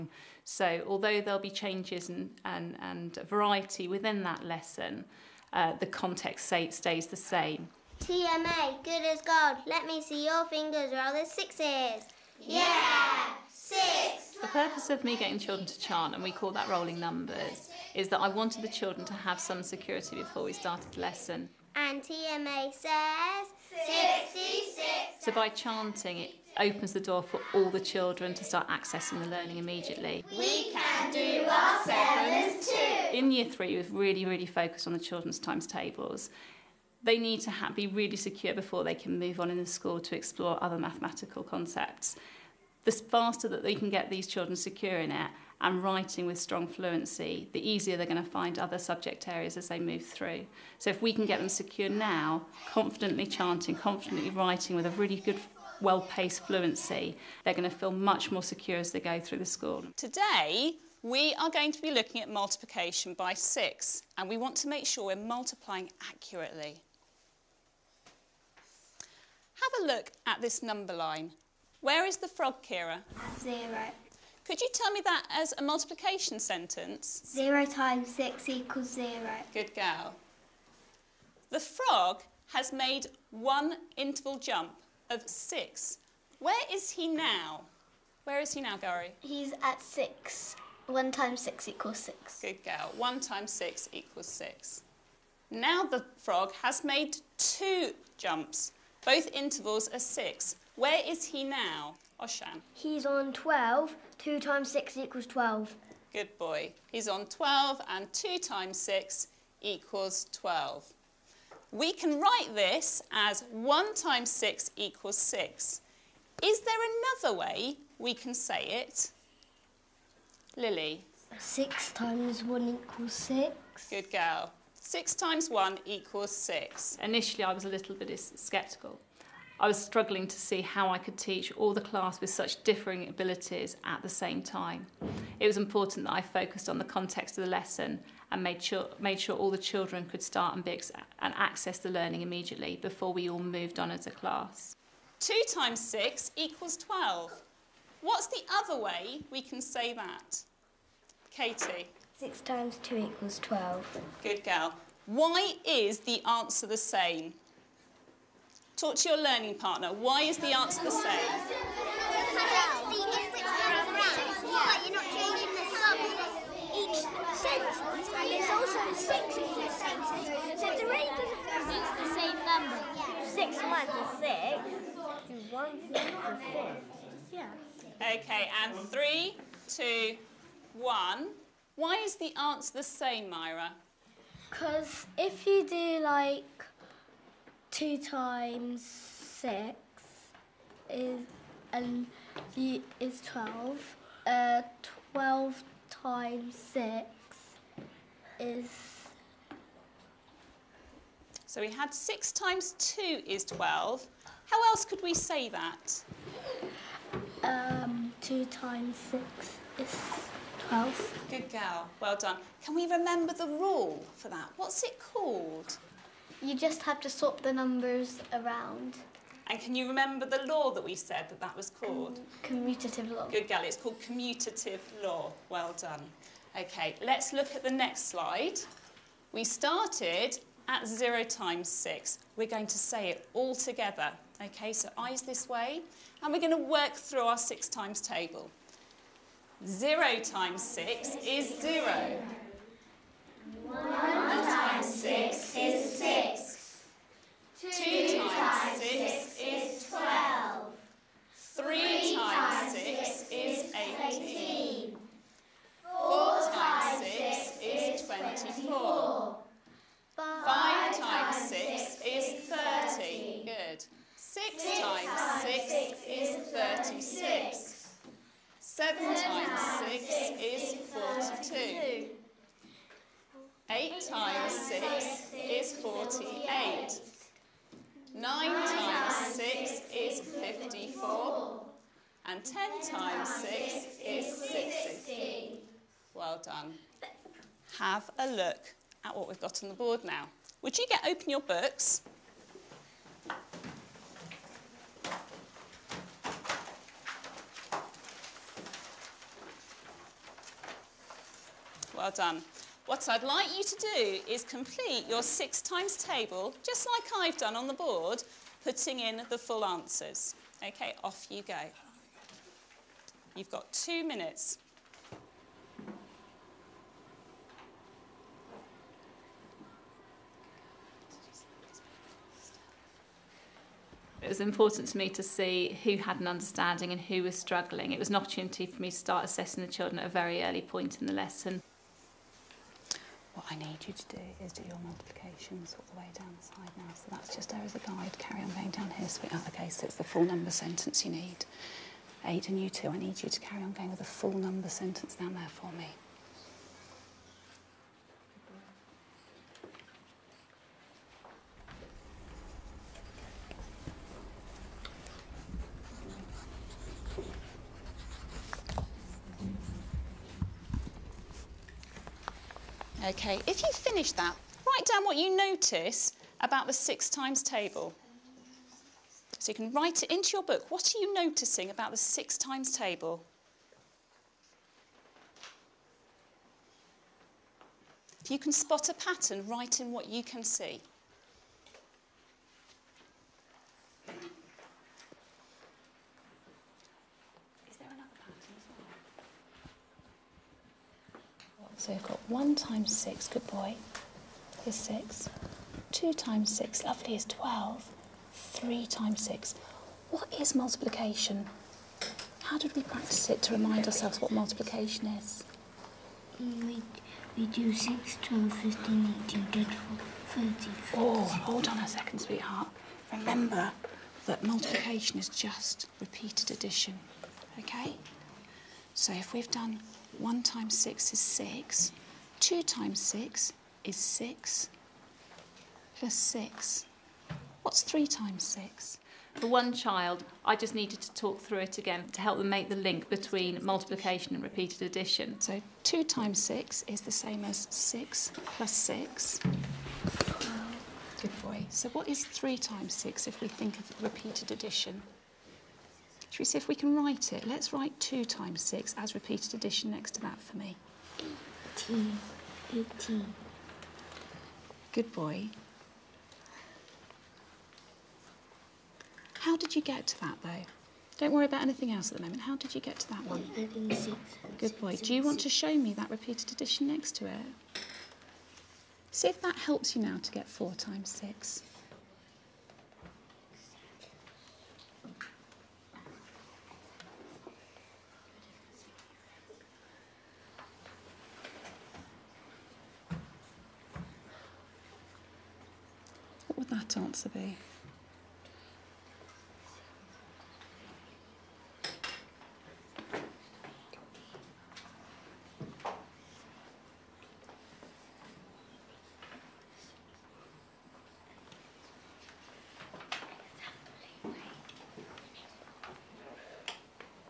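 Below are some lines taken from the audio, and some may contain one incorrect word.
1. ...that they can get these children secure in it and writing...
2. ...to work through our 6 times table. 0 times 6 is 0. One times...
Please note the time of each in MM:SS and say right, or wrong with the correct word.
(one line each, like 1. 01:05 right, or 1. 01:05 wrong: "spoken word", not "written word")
1. 00:43 right
2. 03:56 right.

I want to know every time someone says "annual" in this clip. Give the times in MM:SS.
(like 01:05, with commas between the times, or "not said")
not said.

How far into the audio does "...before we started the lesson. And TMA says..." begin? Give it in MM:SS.
00:20.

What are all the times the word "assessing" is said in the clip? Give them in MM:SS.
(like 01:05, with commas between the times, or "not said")
05:29.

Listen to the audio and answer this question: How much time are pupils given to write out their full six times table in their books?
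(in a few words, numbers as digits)
2 minutes.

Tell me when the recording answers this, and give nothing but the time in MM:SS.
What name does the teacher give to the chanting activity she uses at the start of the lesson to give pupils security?
00:16.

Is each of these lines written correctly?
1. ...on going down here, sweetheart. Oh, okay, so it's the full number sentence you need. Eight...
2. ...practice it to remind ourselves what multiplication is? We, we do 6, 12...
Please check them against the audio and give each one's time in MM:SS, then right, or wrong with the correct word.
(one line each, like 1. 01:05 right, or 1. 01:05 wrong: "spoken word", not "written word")
1. 05:38 right
2. 06:42 right.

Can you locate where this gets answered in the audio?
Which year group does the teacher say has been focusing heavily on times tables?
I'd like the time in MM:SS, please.
00:33.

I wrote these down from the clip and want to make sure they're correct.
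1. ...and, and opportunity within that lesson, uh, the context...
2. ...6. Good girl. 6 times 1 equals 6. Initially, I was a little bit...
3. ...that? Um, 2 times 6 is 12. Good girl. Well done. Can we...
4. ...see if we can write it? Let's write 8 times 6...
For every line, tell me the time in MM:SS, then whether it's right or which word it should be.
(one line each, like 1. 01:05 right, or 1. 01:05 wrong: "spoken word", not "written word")
1. 00:02 wrong: "variety", not "opportunity"
2. 02:03 right
3. 03:25 right
4. 07:26 wrong: "2", not "8".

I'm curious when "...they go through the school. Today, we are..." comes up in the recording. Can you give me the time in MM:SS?
00:58.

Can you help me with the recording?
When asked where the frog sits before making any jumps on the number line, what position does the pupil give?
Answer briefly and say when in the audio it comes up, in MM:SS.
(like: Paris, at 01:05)
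0, at 01:12.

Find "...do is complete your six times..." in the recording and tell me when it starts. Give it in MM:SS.
05:03.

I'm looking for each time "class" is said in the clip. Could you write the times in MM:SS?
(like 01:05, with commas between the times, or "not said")
02:11, 02:24.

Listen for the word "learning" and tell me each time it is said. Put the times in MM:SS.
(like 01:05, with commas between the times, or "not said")
00:29, 02:21, 02:39.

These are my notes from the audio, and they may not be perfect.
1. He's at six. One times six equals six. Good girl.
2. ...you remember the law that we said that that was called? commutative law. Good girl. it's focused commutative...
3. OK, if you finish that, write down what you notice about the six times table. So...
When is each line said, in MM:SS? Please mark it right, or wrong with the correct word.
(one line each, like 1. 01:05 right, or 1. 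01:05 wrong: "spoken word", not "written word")
1. 01:29 right
2. 03:39 wrong: "called", not "focused"
3. 06:03 right.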